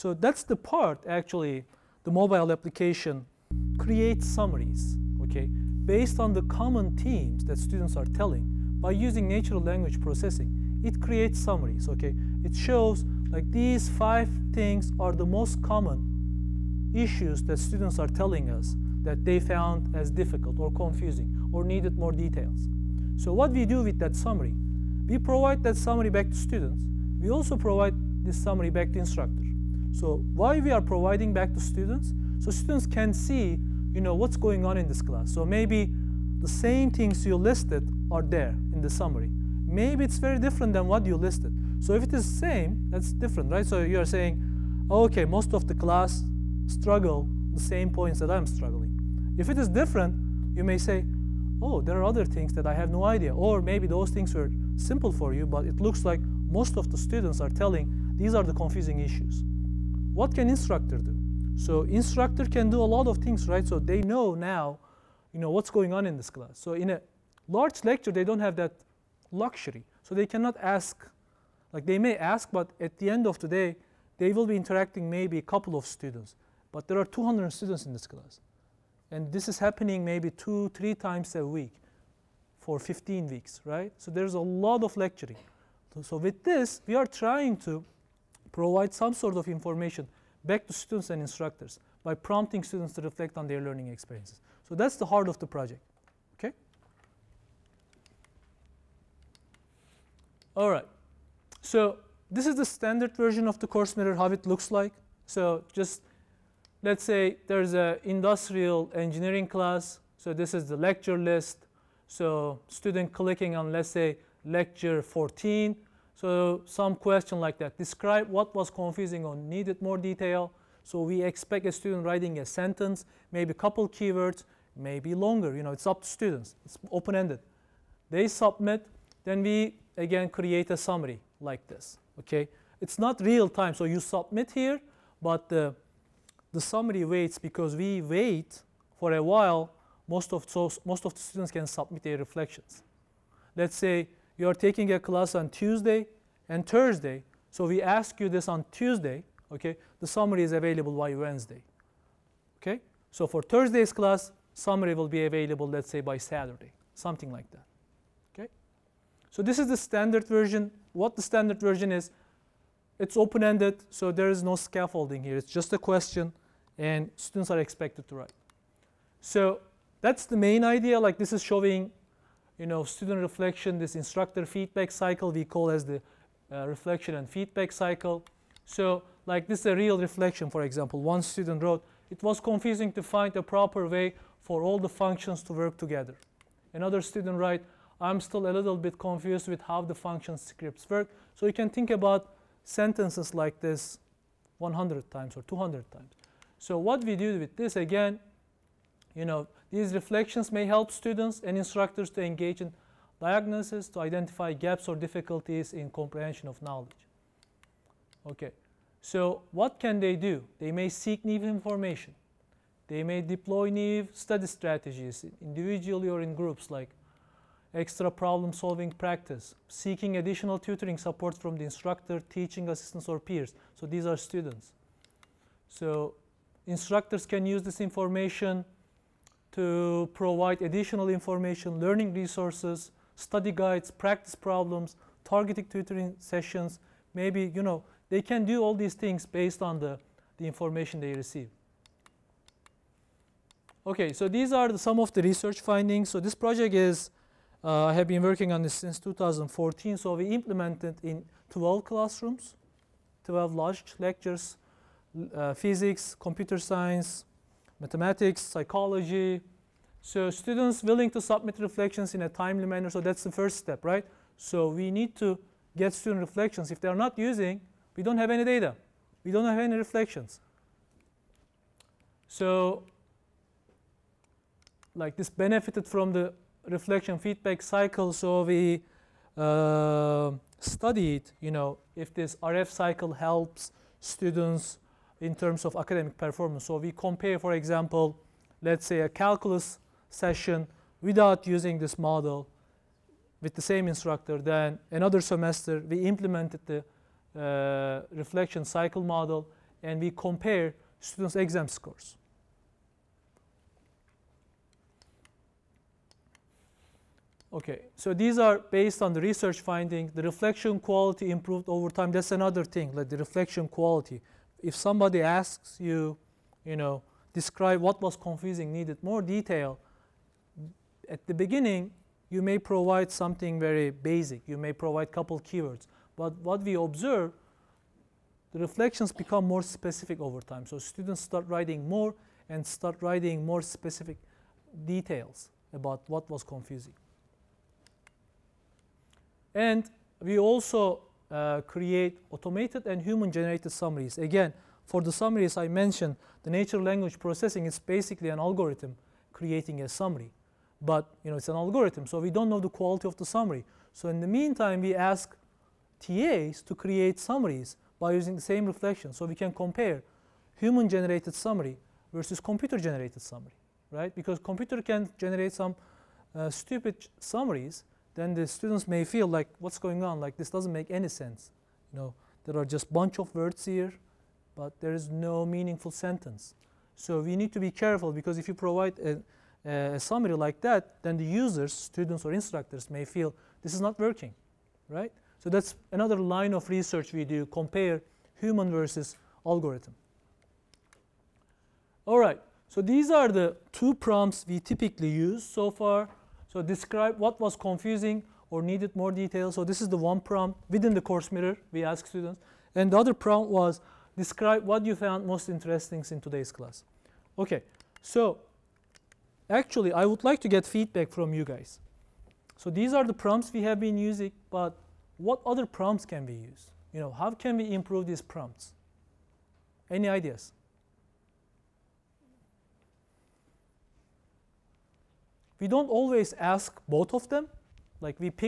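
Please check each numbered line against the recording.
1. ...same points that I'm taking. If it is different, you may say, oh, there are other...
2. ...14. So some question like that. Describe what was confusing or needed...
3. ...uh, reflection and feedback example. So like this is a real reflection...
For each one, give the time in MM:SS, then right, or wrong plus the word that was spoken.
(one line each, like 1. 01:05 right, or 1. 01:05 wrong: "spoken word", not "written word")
1. 00:47 wrong: "struggling", not "taking"
2. 01:55 right
3. 02:56 wrong: "cycle", not "example".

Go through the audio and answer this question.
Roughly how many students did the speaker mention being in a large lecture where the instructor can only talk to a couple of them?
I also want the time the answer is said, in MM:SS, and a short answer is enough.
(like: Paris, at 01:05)
200, at 01:17.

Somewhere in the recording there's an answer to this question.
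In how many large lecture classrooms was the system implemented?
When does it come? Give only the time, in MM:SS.
04:11.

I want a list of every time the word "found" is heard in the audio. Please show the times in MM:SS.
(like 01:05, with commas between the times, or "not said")
00:19, 06:44.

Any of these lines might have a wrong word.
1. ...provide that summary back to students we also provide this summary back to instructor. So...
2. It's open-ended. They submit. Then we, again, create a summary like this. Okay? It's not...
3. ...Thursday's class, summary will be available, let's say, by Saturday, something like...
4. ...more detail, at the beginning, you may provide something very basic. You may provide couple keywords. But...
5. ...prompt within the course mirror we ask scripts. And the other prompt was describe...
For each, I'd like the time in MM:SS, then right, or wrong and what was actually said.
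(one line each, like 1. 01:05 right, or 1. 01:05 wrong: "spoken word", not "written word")
1. 00:25 right
2. 02:06 right
3. 02:33 right
4. 05:19 right
5. 06:40 wrong: "students", not "scripts".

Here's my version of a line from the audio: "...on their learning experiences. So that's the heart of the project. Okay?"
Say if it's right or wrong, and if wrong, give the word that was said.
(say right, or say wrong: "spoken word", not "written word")
right.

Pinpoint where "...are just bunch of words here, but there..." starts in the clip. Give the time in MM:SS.
06:12.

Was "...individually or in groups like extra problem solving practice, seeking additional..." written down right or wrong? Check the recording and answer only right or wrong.
right.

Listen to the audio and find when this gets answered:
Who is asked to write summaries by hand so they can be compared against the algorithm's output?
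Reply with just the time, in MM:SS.
05:56.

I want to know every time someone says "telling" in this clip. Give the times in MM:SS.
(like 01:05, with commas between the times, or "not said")
00:08, 00:18, 00:57.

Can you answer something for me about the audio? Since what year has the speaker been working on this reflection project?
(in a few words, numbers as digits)
2014.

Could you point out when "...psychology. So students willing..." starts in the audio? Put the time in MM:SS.
04:18.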